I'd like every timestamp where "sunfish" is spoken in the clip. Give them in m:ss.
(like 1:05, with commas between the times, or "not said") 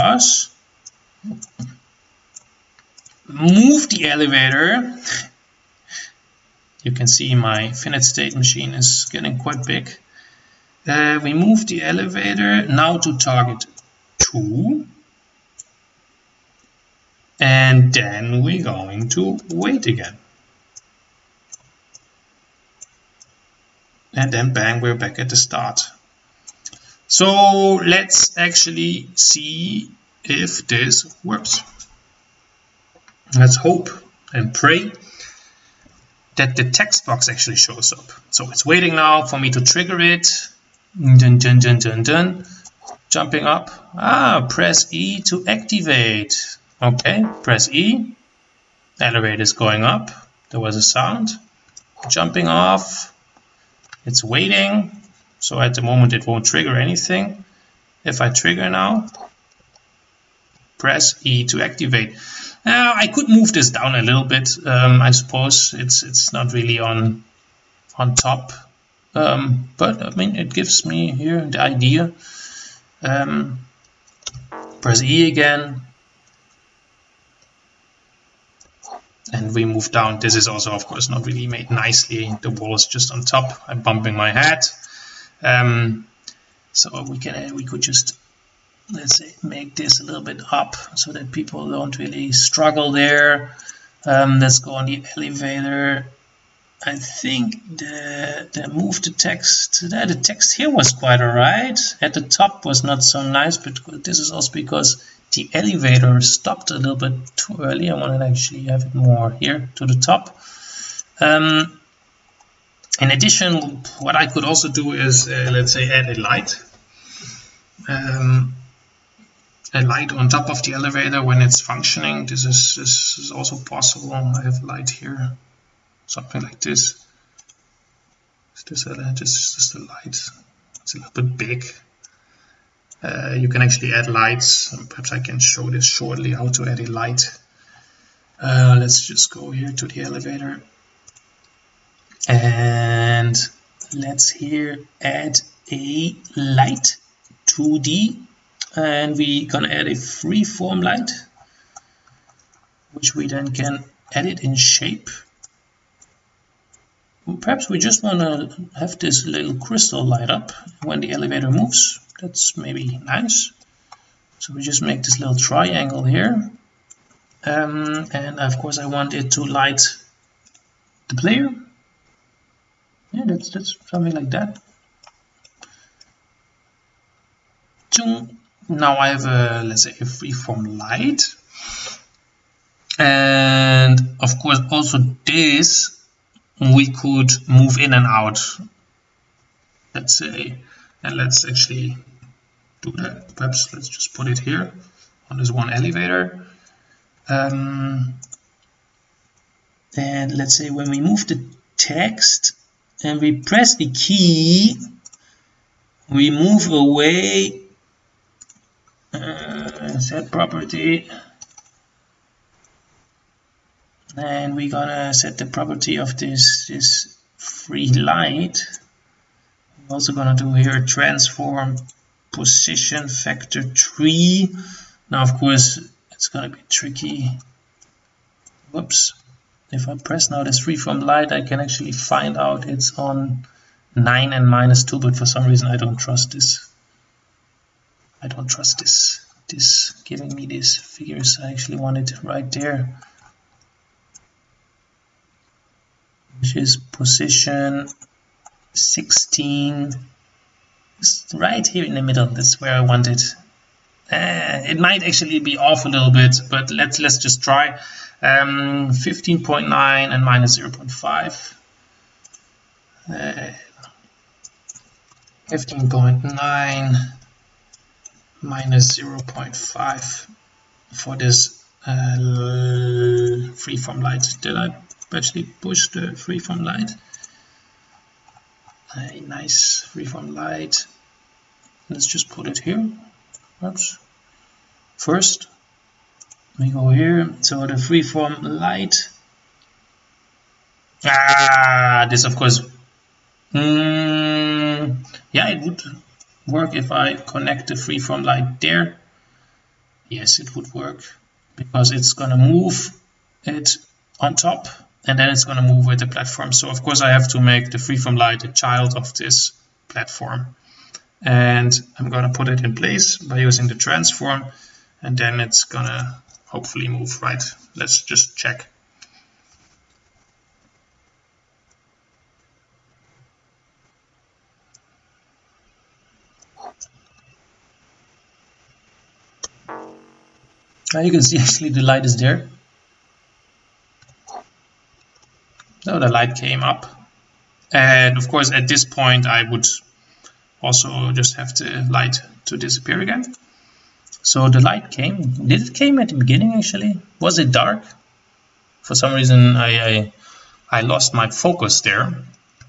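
not said.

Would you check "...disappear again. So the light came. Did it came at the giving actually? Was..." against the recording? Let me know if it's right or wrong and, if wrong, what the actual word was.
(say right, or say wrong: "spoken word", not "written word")
wrong: "beginning", not "giving".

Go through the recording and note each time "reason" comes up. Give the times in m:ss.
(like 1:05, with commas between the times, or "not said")
3:55, 5:49.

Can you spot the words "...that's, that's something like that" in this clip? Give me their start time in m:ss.
2:53.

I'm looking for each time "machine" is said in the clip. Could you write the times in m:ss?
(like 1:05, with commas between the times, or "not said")
0:08.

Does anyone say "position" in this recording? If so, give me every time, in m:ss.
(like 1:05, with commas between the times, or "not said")
3:42, 4:06.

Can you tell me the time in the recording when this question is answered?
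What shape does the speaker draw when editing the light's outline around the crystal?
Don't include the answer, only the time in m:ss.
2:45.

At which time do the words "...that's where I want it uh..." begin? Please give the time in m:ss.
4:12.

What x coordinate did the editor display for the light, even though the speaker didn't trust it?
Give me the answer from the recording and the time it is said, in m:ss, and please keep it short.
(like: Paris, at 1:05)
9, at 3:52.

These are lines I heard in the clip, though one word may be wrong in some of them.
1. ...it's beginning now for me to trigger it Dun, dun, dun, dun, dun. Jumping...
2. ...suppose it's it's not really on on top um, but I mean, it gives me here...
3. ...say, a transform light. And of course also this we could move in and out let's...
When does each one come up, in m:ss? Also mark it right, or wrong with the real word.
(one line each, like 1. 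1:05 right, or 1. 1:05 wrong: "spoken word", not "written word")
1. 0:38 wrong: "waiting", not "beginning"
2. 1:05 right
3. 2:59 wrong: "freeform", not "transform".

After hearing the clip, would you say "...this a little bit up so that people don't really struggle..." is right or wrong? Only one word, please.
right.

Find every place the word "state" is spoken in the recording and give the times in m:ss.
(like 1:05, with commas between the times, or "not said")
0:08.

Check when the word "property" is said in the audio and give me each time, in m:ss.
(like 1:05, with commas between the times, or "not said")
3:30, 3:35.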